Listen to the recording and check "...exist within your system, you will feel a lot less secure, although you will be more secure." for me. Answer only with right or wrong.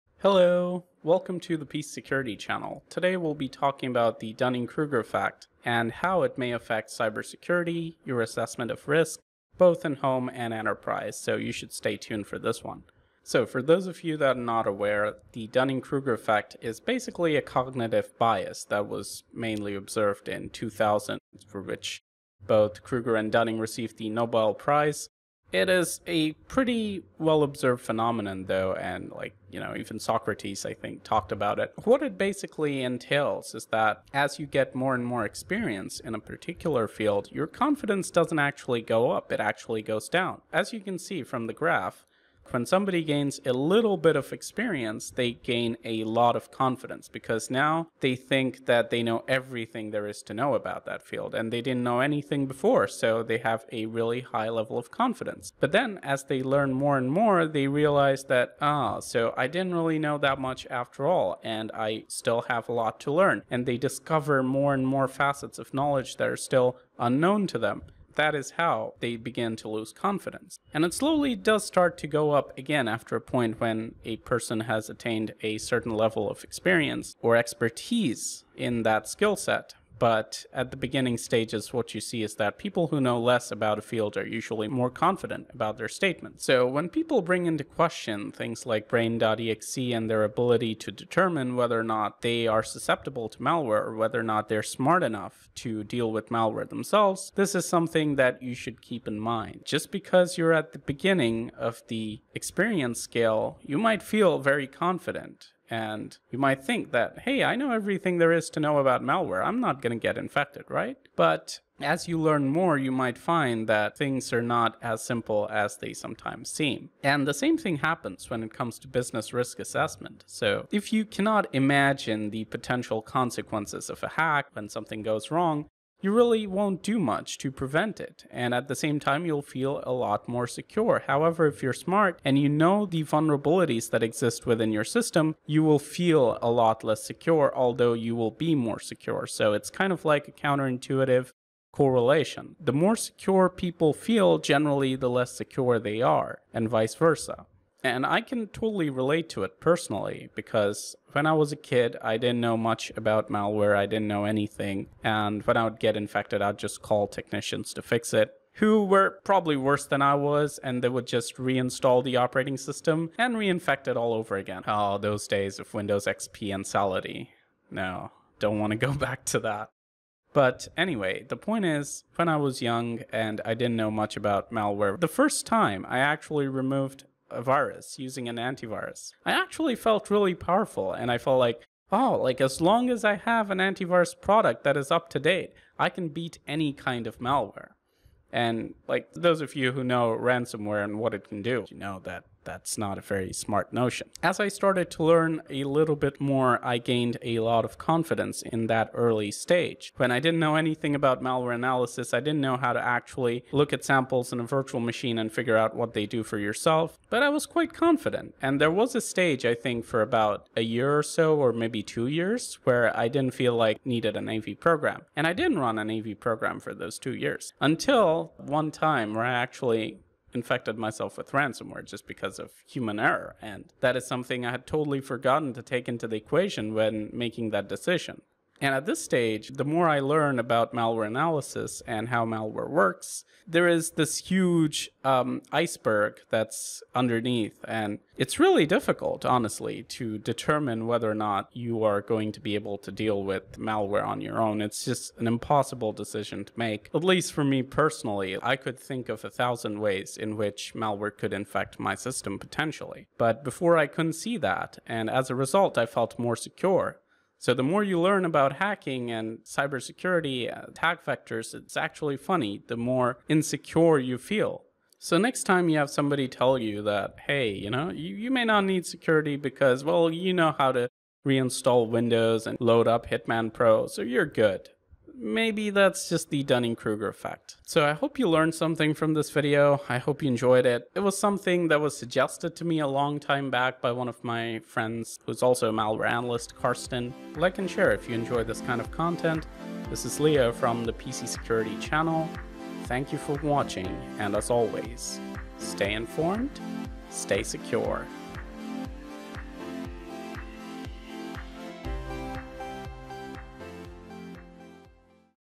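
right.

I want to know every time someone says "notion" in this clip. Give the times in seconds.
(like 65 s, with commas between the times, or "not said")
193 s.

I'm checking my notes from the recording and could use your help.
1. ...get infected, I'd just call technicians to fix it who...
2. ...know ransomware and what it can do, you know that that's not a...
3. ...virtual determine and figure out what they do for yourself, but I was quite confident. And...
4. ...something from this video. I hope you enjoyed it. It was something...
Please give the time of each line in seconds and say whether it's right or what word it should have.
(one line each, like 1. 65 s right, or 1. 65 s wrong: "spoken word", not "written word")
1. 155 s right
2. 189 s right
3. 204 s wrong: "machine", not "determine"
4. 278 s right.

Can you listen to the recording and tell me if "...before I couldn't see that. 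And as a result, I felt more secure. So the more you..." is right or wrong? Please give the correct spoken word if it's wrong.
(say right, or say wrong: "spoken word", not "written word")
right.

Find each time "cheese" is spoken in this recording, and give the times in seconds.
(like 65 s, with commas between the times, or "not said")
not said.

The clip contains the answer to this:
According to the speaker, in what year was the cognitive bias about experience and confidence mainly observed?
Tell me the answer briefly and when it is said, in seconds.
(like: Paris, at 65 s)
2000, at 20 s.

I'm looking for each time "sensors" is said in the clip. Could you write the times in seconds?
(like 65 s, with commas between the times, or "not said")
not said.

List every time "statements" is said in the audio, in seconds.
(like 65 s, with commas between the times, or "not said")
85 s.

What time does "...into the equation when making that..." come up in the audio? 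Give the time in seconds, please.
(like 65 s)
225 s.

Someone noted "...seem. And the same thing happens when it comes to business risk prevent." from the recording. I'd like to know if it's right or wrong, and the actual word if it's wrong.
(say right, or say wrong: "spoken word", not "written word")
wrong: "assessment", not "prevent".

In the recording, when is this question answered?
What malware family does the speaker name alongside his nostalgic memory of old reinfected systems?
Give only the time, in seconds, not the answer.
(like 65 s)
166 s.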